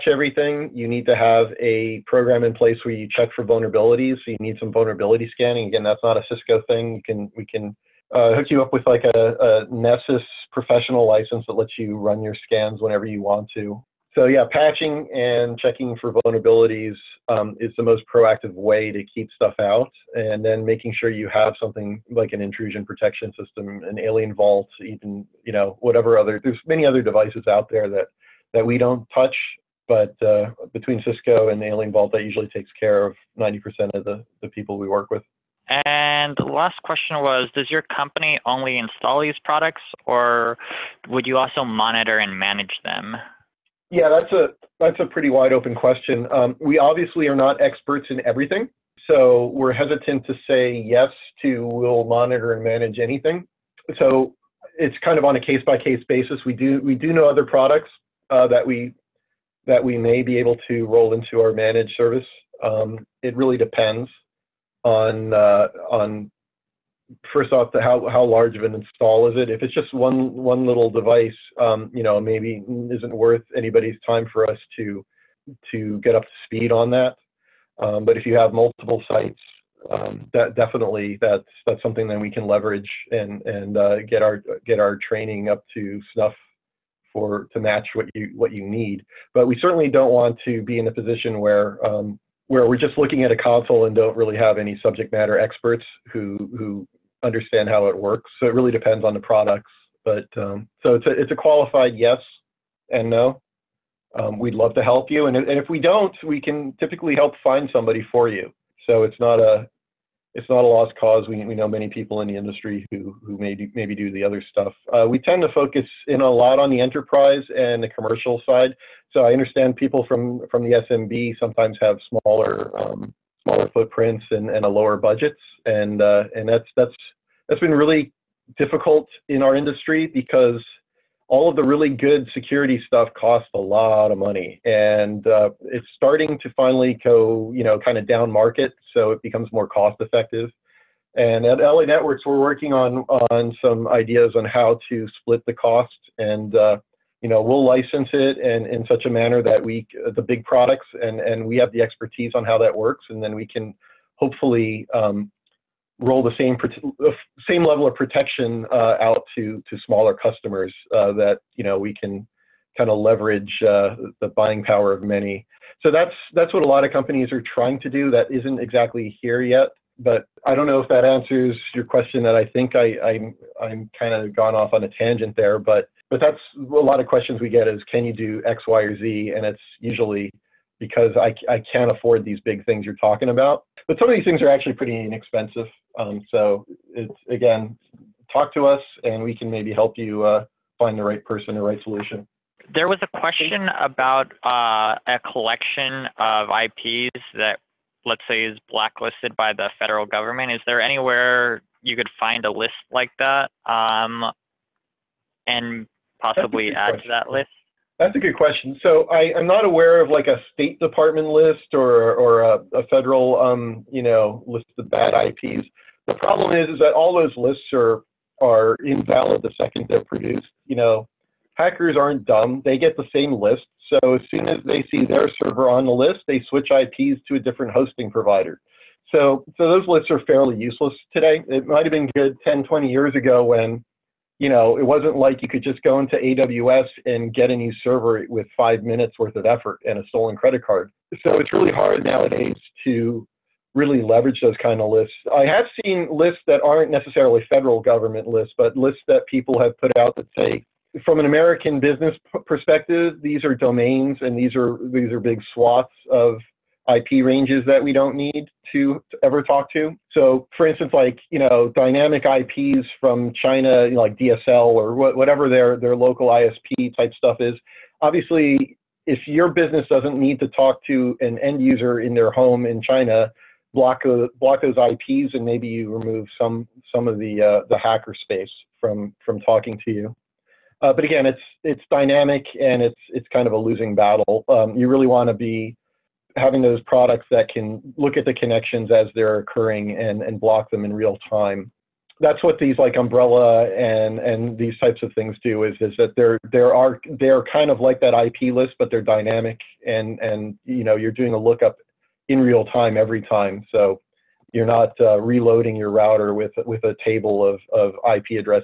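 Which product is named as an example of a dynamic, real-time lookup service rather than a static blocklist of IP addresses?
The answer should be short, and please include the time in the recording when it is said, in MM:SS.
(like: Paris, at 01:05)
Umbrella, at 04:52.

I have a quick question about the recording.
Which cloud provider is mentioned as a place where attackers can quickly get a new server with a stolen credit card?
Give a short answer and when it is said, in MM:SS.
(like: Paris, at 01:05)
AWS, at 03:56.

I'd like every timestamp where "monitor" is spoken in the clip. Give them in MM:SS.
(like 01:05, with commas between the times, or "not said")
00:41, 00:52.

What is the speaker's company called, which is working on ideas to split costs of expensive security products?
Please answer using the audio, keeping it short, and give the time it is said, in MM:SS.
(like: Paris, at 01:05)
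La Networks, at 02:21.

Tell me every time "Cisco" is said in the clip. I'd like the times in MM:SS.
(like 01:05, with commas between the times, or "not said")
00:06, 00:31.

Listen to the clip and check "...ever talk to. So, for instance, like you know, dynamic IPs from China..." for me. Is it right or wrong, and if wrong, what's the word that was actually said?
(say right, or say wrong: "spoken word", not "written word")
right.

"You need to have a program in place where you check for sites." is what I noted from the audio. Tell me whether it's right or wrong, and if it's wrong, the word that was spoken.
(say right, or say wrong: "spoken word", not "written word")
wrong: "vulnerabilities", not "sites".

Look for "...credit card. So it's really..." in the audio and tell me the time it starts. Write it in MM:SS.
04:00.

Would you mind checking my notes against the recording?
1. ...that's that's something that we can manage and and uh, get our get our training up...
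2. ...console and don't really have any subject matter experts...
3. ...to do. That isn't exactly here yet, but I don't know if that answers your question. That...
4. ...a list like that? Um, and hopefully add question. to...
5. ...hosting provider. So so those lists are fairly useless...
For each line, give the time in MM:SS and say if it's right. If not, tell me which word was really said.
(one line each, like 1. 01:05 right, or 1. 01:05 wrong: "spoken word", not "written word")
1. 01:21 wrong: "leverage", not "manage"
2. 01:33 right
3. 02:47 right
4. 03:22 wrong: "possibly", not "hopefully"
5. 03:47 right.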